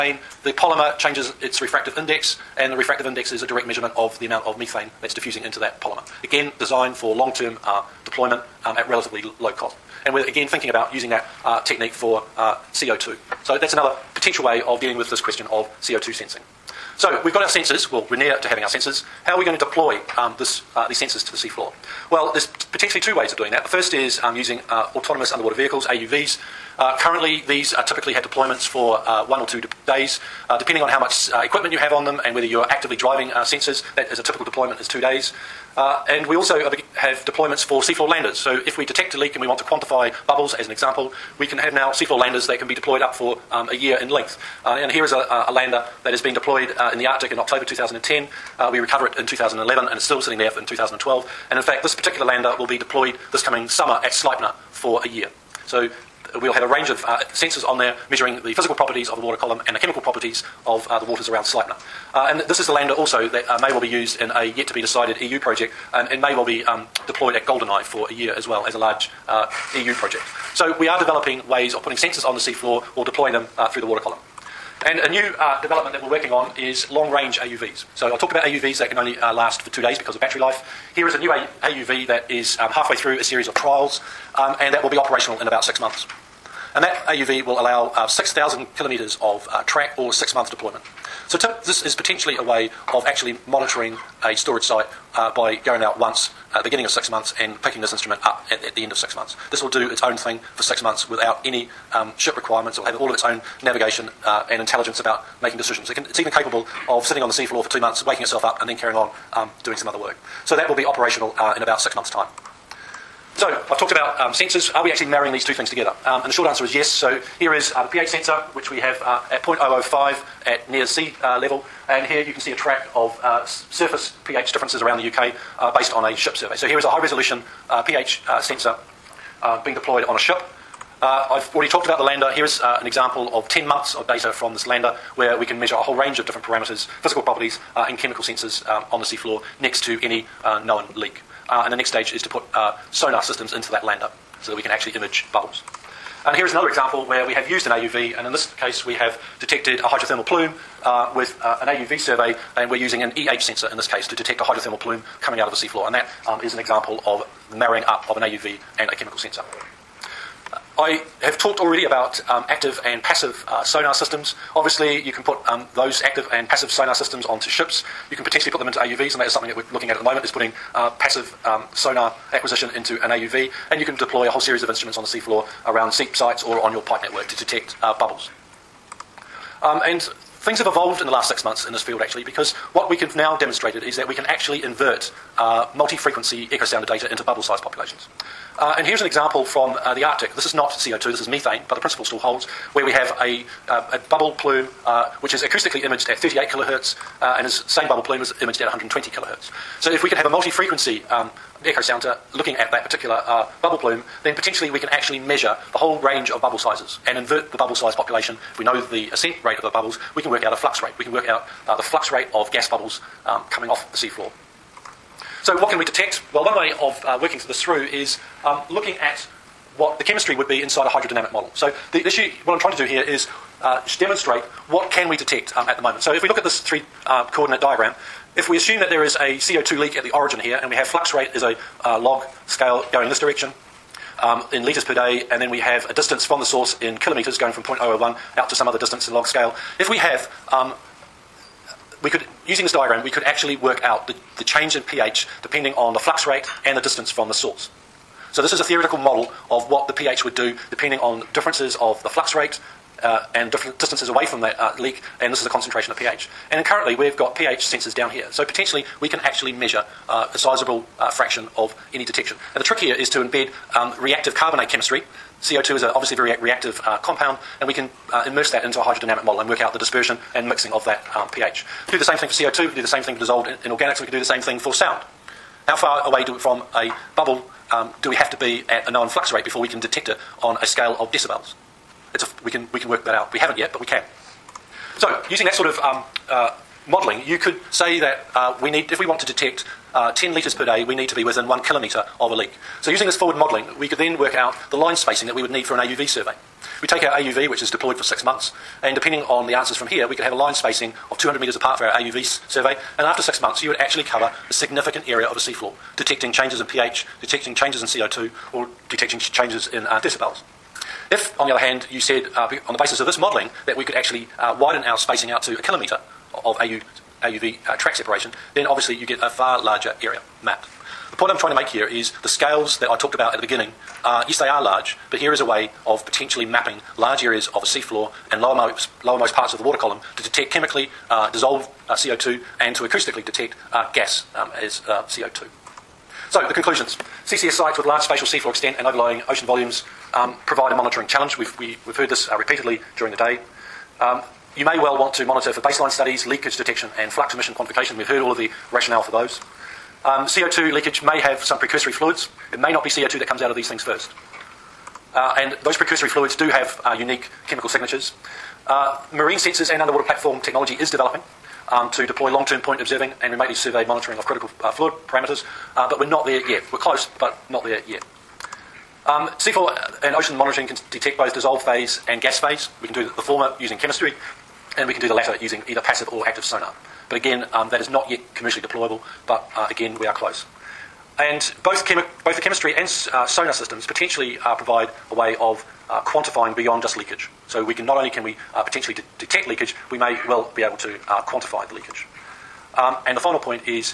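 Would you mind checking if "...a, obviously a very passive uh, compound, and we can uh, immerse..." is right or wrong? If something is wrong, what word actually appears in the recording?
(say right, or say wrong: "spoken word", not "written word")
wrong: "reactive", not "passive".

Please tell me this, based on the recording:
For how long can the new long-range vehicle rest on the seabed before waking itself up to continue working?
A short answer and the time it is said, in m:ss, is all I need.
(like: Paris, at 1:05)
2 months, at 1:47.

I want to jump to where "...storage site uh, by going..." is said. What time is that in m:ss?
1:34.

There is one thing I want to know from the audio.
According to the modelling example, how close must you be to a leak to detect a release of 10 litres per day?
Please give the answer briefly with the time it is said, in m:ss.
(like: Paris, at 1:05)
1 kilometre, at 4:51.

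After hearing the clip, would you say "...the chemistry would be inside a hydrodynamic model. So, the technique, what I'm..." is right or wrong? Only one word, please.
wrong.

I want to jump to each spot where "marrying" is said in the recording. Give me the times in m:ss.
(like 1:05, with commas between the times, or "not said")
1:55, 2:37.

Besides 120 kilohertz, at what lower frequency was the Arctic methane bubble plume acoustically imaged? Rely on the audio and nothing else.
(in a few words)
38 kilohertz.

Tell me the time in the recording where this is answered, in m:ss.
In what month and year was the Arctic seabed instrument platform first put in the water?
0:47.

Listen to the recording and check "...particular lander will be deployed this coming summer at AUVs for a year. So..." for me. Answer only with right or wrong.
wrong.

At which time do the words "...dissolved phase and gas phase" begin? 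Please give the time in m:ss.
6:11.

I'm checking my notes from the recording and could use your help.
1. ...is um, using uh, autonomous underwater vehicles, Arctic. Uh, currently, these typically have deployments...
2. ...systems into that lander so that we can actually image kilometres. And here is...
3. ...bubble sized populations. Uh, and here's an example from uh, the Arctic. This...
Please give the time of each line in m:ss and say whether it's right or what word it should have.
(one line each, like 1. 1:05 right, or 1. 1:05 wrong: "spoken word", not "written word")
1. 0:23 wrong: "AUVs", not "Arctic"
2. 2:23 wrong: "bubbles", not "kilometres"
3. 3:07 right.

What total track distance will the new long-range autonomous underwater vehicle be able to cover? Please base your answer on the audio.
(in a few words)
6,000 kilometres.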